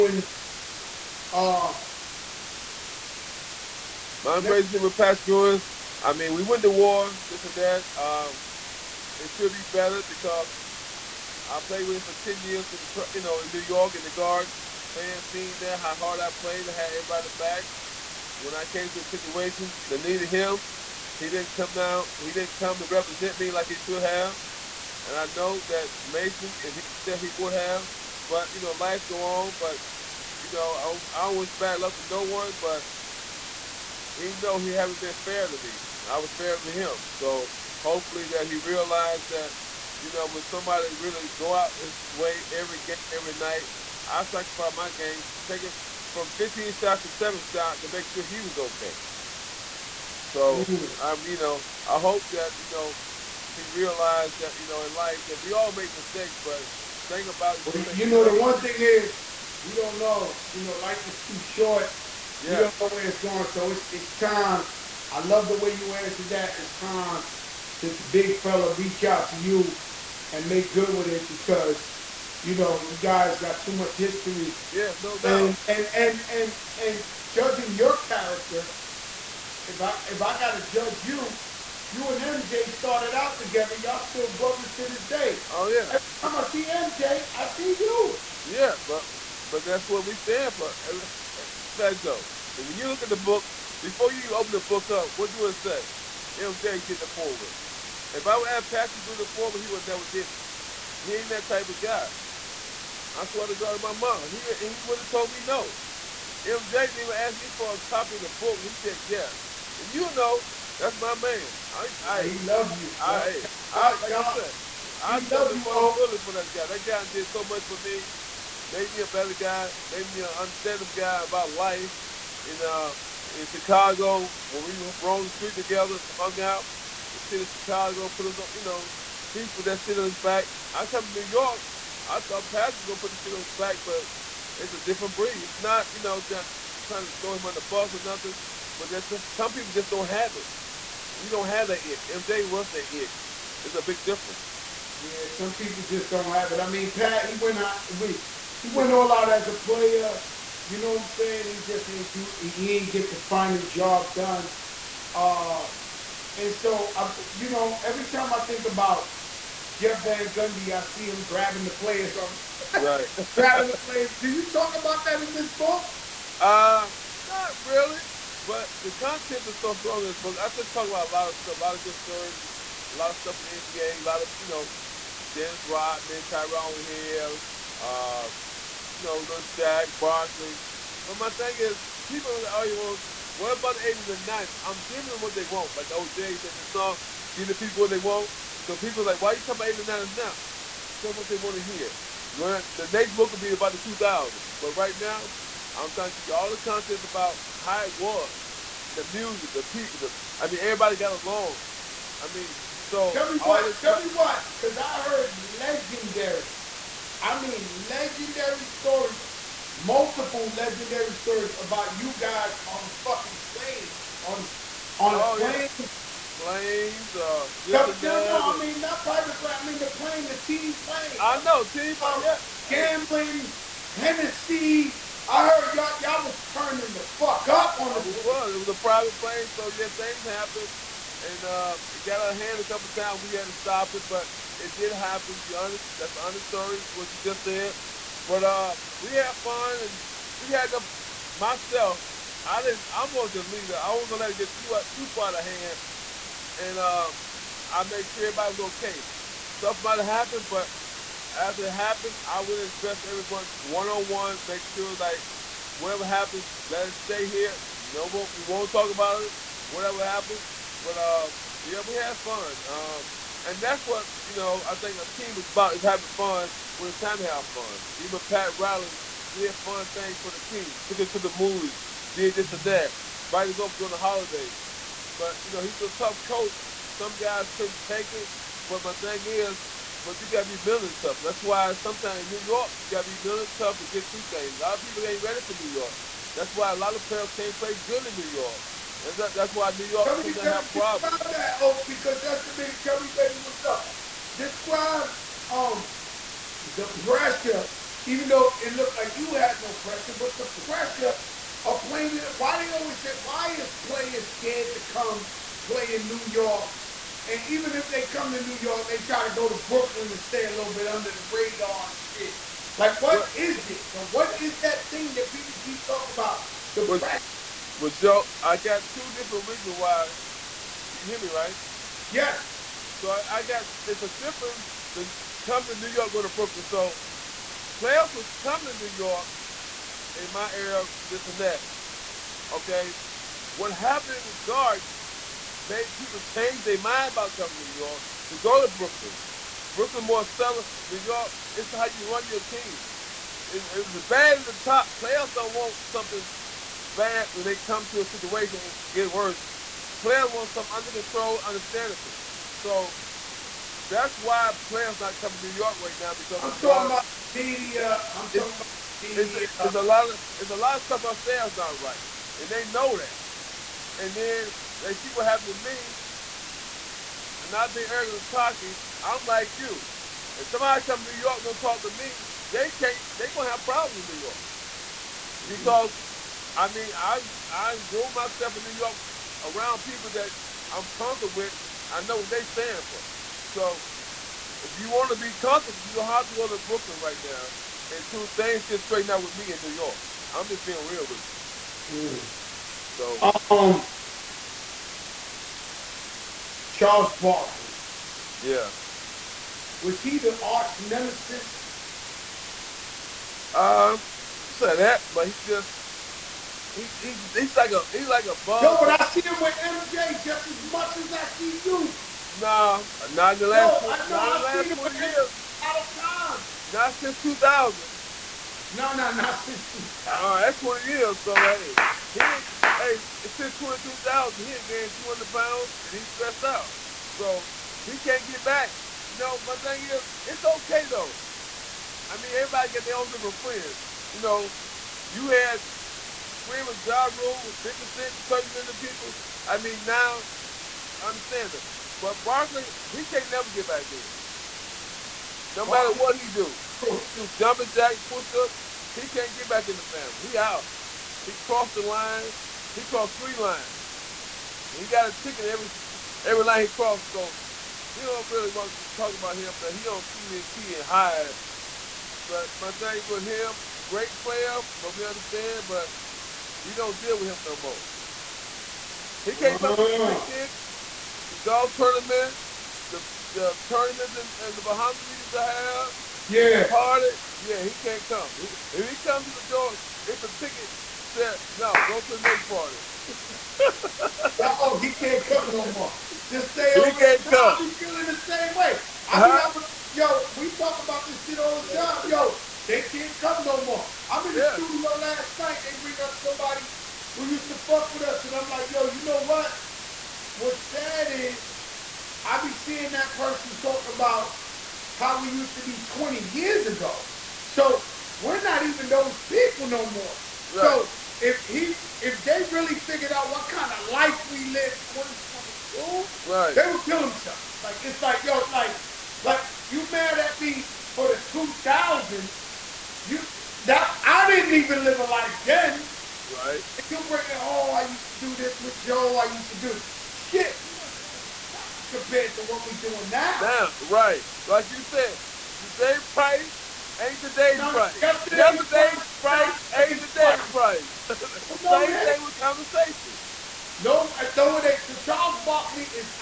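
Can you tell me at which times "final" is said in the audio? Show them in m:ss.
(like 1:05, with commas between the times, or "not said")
2:33.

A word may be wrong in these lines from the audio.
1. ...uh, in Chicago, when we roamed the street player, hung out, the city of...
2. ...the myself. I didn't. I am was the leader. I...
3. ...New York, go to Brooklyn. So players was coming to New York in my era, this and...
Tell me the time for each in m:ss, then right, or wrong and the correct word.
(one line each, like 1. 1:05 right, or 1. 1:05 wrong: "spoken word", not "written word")
1. 2:02 wrong: "together", not "player"
2. 4:00 right
3. 5:25 right.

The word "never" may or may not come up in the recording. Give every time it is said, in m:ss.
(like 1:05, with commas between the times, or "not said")
1:39, 7:23.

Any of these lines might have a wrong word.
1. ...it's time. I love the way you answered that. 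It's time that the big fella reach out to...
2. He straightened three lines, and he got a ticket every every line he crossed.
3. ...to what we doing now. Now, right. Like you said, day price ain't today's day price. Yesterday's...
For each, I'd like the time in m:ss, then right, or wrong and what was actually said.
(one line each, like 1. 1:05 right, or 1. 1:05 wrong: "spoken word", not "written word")
1. 1:03 right
2. 7:32 wrong: "crossed", not "straightened"
3. 8:52 right.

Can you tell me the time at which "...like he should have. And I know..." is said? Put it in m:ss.
0:23.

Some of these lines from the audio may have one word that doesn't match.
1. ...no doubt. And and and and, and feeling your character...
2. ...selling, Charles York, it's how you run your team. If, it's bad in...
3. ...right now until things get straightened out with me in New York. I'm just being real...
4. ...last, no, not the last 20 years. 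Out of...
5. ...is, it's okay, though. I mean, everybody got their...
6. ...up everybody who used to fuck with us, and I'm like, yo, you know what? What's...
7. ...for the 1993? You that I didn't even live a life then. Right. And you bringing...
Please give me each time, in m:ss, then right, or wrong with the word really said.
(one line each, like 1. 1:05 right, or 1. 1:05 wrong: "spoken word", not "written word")
1. 1:15 wrong: "judging", not "feeling"
2. 5:40 wrong: "New", not "Charles"
3. 6:26 right
4. 6:53 right
5. 7:09 right
6. 8:16 wrong: "somebody", not "everybody"
7. 8:40 wrong: "2000", not "1993".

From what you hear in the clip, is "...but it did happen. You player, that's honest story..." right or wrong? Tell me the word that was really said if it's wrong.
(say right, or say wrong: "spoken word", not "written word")
wrong: "under", not "player".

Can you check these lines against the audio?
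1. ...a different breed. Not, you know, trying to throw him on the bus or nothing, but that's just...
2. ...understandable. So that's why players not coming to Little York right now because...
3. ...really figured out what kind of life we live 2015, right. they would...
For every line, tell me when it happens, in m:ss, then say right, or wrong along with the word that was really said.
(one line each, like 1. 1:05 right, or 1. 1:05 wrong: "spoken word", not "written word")
1. 2:14 right
2. 5:51 wrong: "New", not "Little"
3. 8:32 wrong: "2022", not "2015".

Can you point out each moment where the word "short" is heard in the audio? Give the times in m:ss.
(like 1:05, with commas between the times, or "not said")
1:01.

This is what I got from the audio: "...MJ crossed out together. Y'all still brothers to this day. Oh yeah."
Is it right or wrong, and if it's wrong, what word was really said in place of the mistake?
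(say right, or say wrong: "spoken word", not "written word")
wrong: "started", not "crossed".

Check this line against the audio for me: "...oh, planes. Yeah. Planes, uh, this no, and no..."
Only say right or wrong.
right.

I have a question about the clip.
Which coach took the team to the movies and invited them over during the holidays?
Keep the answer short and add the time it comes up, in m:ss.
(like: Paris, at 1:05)
Pat Riley, at 4:28.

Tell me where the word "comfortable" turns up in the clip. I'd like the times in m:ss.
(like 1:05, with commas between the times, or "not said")
6:20, 6:25.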